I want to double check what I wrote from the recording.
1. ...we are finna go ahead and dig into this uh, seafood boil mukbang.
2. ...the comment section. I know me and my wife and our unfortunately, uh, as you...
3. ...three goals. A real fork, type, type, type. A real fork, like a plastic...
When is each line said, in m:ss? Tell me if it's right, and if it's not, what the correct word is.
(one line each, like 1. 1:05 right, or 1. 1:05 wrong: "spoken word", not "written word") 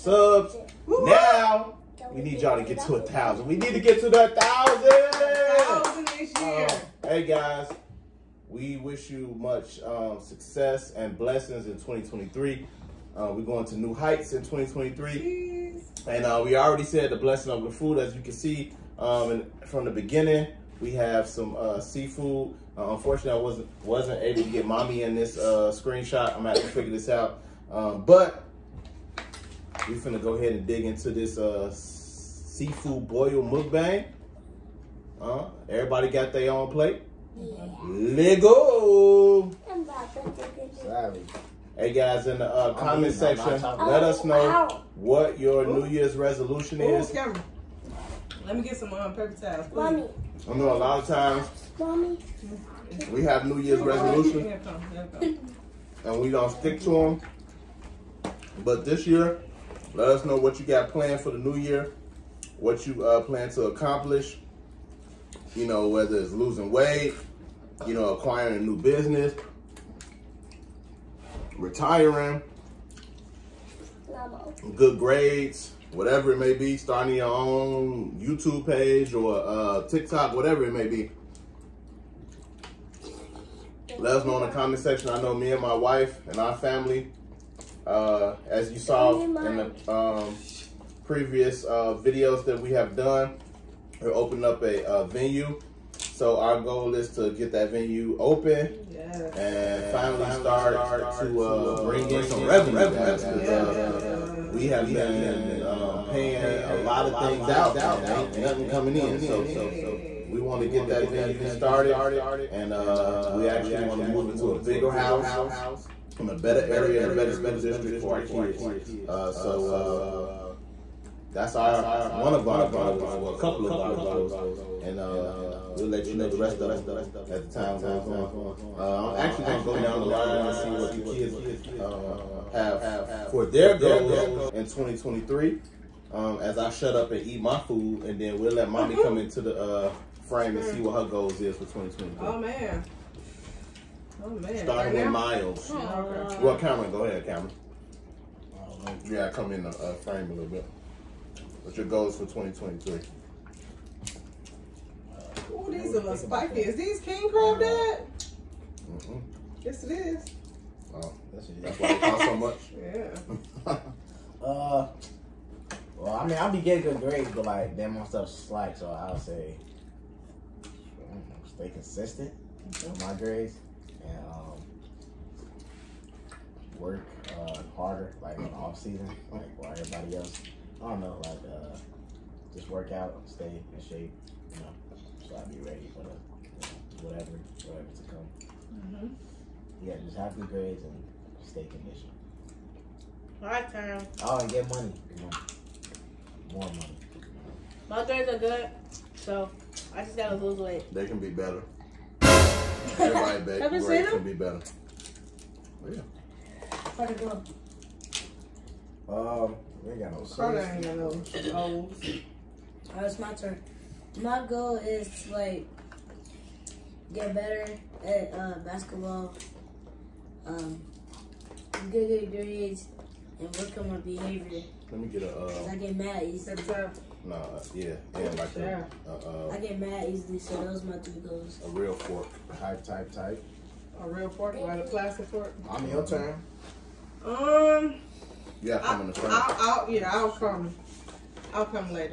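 1. 0:29 right
2. 1:24 wrong: "family", not "unfortunately"
3. 3:50 right.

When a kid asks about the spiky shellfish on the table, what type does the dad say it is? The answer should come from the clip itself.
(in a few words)
King crab.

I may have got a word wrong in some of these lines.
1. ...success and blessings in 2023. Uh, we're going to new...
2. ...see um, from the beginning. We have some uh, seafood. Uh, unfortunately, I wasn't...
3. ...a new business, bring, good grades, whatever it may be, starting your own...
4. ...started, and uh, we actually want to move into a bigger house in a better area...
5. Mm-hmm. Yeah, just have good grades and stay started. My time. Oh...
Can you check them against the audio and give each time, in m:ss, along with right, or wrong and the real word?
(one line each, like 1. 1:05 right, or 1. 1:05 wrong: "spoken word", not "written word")
1. 0:10 right
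2. 0:18 right
3. 1:08 wrong: "retiring", not "bring"
4. 1:51 right
5. 3:08 wrong: "conditioned", not "started".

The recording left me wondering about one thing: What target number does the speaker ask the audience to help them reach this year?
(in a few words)
1000.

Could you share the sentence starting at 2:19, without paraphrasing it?
come into the uh, frame and see what her goals is for 2023.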